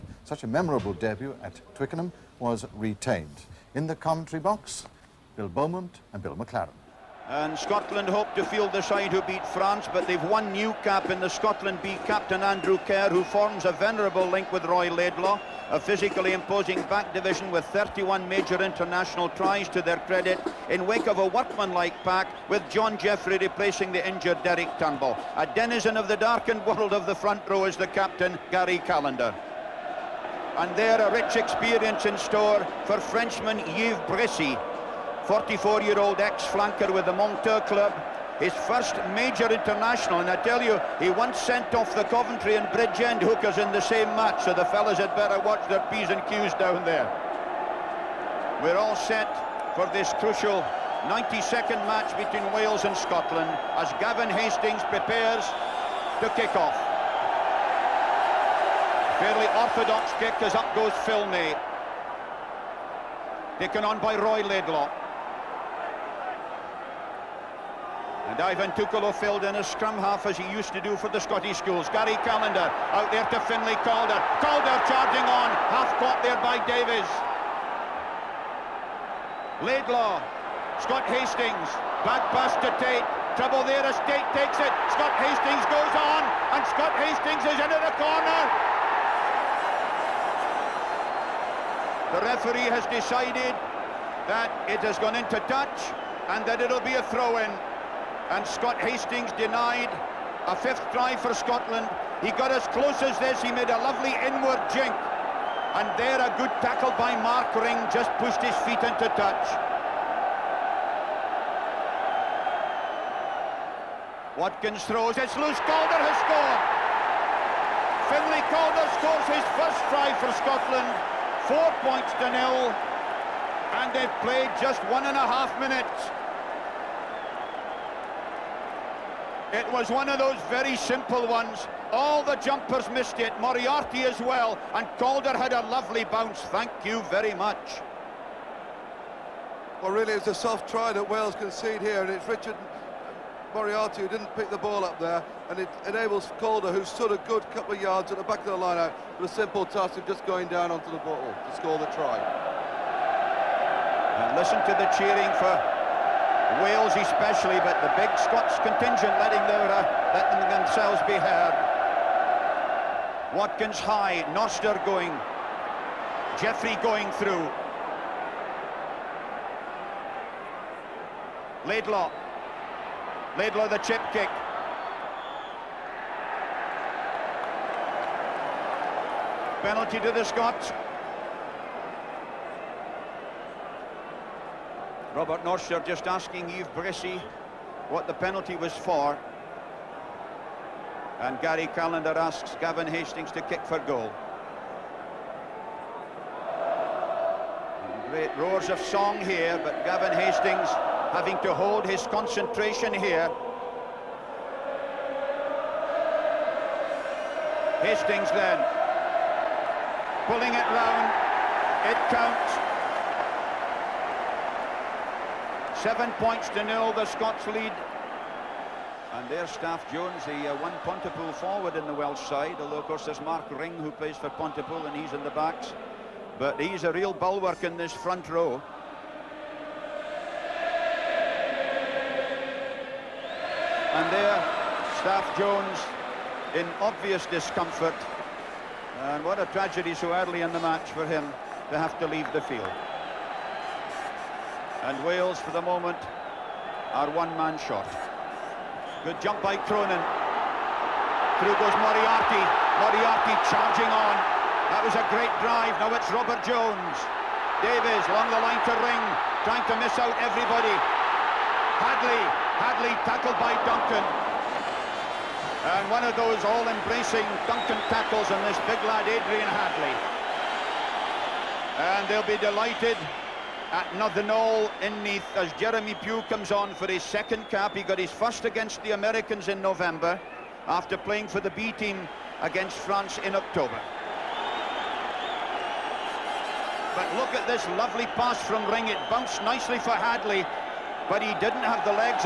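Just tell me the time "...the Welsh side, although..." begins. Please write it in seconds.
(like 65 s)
221 s.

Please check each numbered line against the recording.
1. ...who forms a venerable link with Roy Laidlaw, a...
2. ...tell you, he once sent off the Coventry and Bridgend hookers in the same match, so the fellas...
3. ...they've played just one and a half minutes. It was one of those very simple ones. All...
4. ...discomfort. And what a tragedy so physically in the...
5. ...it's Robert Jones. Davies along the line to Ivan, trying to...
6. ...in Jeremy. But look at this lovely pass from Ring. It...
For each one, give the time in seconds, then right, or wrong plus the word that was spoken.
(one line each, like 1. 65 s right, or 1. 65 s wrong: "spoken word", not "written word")
1. 13 s right
2. 40 s right
3. 123 s right
4. 237 s wrong: "early", not "physically"
5. 255 s wrong: "Ring", not "Ivan"
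6. 283 s wrong: "October", not "Jeremy".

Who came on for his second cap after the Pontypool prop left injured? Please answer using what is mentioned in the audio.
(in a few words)
Jeremy Pugh.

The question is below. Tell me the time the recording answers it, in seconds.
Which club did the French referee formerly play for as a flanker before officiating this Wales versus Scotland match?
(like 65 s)
37 s.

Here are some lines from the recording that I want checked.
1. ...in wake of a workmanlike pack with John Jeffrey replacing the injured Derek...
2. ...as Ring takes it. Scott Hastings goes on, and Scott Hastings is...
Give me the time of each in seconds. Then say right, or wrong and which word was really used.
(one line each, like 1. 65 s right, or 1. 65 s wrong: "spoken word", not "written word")
1. 20 s right
2. 83 s wrong: "Tait", not "Ring".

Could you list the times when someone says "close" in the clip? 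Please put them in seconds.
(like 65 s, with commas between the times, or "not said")
102 s.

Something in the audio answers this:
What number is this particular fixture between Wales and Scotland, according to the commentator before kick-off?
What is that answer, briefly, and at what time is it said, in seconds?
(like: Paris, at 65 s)
92nd, at 51 s.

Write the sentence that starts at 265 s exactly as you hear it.
And one of those all-embracing Duncan tackles on this big lad, Adrian Hadley.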